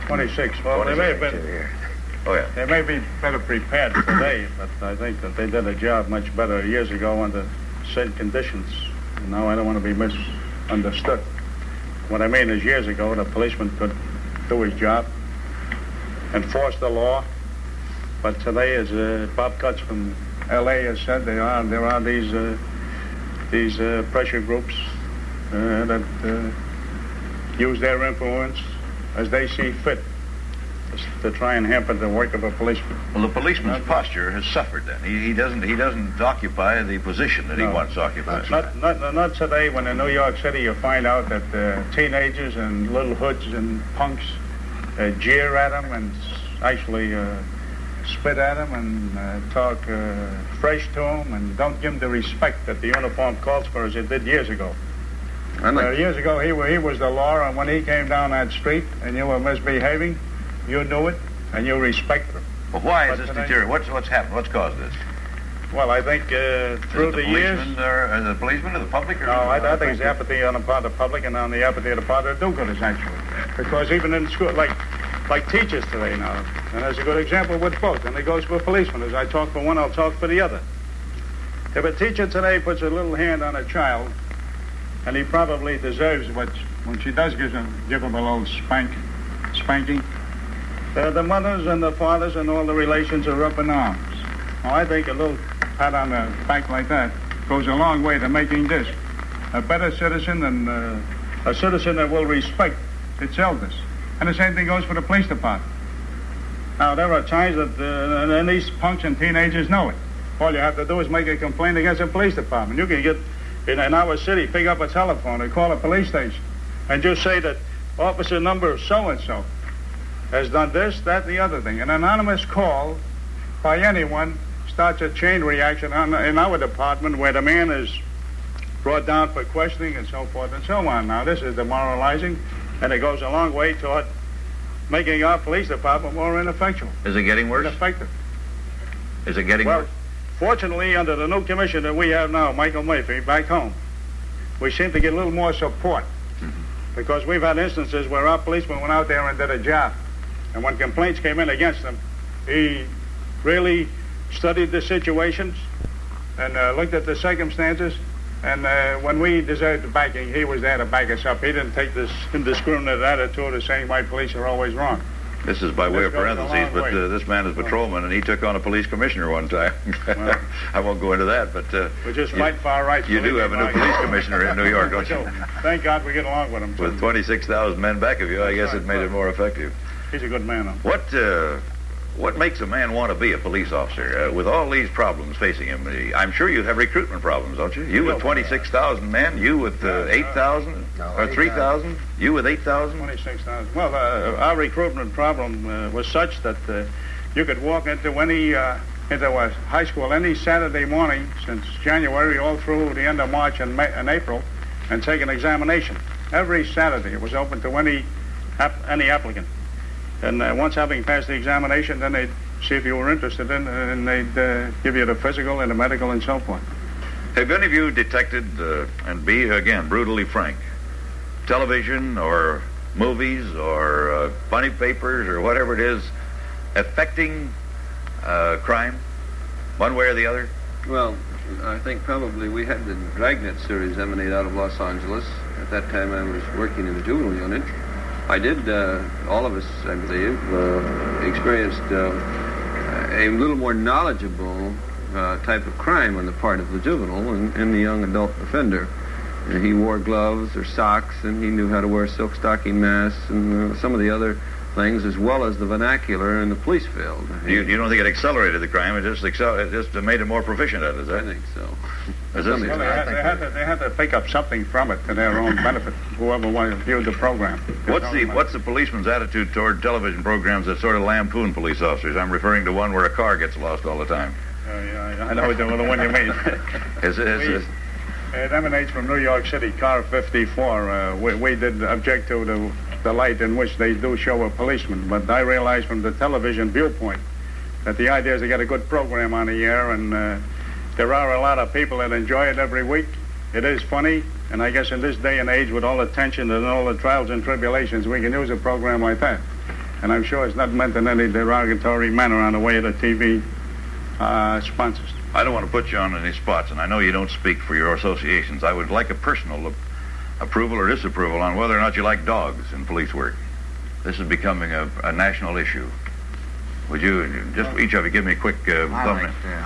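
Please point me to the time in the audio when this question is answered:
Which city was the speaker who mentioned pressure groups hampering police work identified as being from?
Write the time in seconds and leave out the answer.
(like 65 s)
20 s.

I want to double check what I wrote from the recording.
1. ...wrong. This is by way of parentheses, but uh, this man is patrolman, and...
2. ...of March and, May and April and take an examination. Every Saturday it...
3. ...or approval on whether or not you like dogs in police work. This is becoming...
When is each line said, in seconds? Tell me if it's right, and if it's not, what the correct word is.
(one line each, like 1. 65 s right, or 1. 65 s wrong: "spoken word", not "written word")
1. 164 s right
2. 203 s right
3. 310 s wrong: "disapproval", not "approval".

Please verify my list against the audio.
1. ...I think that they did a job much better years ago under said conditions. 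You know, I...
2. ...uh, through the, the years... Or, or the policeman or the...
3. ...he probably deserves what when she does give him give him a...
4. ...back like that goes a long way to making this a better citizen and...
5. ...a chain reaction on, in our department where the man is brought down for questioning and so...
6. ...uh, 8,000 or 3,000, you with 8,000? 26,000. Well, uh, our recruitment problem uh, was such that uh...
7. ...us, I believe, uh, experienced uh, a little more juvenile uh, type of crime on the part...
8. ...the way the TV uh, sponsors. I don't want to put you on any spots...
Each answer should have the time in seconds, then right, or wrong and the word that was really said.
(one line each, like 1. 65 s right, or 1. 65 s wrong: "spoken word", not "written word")
1. 4 s right
2. 66 s right
3. 85 s right
4. 96 s right
5. 125 s right
6. 189 s right
7. 239 s wrong: "knowledgeable", not "juvenile"
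8. 302 s right.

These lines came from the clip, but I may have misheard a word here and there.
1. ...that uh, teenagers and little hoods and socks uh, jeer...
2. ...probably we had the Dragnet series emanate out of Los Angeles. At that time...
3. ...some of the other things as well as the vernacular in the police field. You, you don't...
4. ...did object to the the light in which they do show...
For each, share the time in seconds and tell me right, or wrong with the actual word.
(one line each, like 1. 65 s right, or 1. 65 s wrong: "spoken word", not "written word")
1. 41 s wrong: "punks", not "socks"
2. 232 s right
3. 253 s right
4. 281 s right.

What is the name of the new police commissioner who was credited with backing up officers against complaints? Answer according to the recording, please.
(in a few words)
Michael Murphy.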